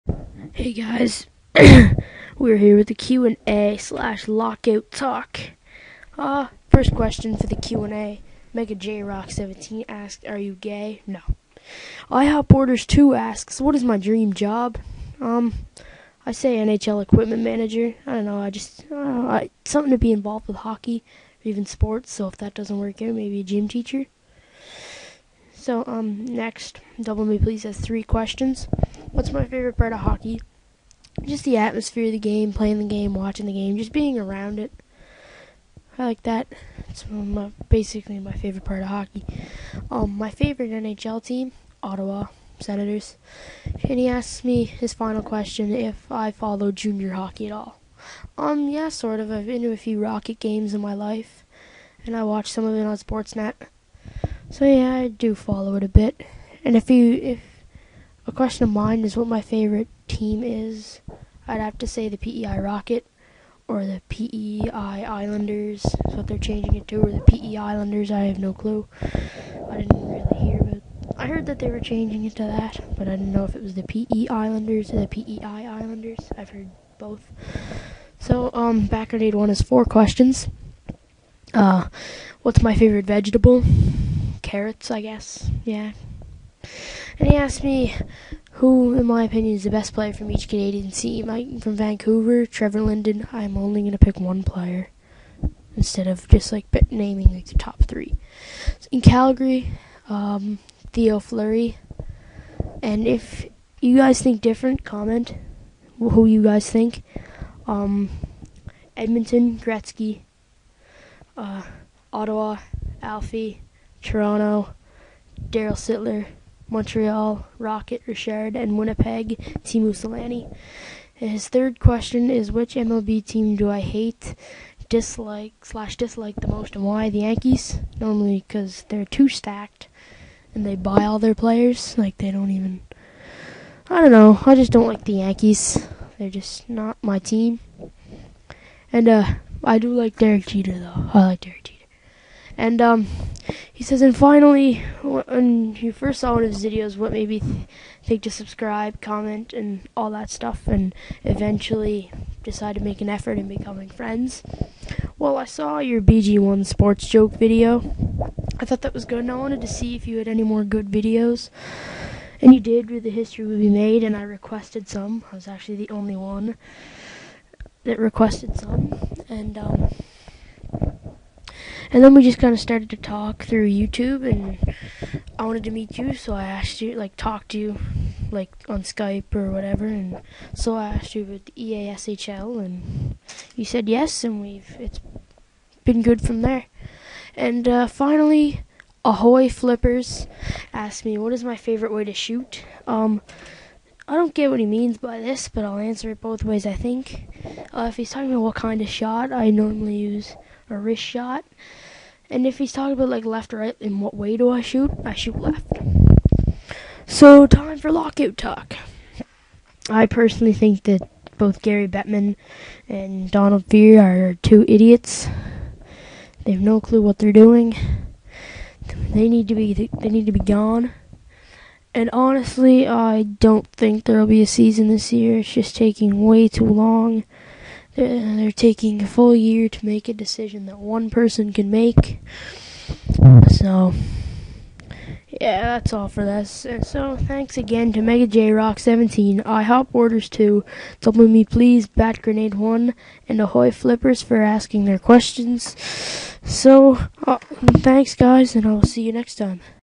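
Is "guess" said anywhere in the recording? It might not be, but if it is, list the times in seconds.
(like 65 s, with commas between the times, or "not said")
85 s.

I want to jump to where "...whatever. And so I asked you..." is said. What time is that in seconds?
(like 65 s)
179 s.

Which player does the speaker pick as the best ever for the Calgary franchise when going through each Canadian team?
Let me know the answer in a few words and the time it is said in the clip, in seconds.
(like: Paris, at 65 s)
Theo Fleury, at 100 s.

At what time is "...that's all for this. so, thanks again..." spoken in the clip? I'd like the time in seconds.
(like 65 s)
235 s.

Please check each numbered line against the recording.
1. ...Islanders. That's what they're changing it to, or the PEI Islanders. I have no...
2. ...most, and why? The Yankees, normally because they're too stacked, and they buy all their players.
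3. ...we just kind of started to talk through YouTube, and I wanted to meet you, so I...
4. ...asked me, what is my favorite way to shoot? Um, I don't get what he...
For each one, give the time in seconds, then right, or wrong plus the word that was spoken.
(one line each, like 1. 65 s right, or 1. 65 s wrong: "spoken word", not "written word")
1. 65 s right
2. 126 s right
3. 172 s right
4. 190 s right.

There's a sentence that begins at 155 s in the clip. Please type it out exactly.
Well, I saw your BG1 sports joke video.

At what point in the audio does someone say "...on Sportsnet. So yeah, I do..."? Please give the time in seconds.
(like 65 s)
52 s.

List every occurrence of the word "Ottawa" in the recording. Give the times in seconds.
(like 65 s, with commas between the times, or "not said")
41 s, 112 s.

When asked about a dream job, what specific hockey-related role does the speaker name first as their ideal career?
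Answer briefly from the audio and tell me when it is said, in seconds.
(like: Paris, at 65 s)
NHL equipment manager, at 16 s.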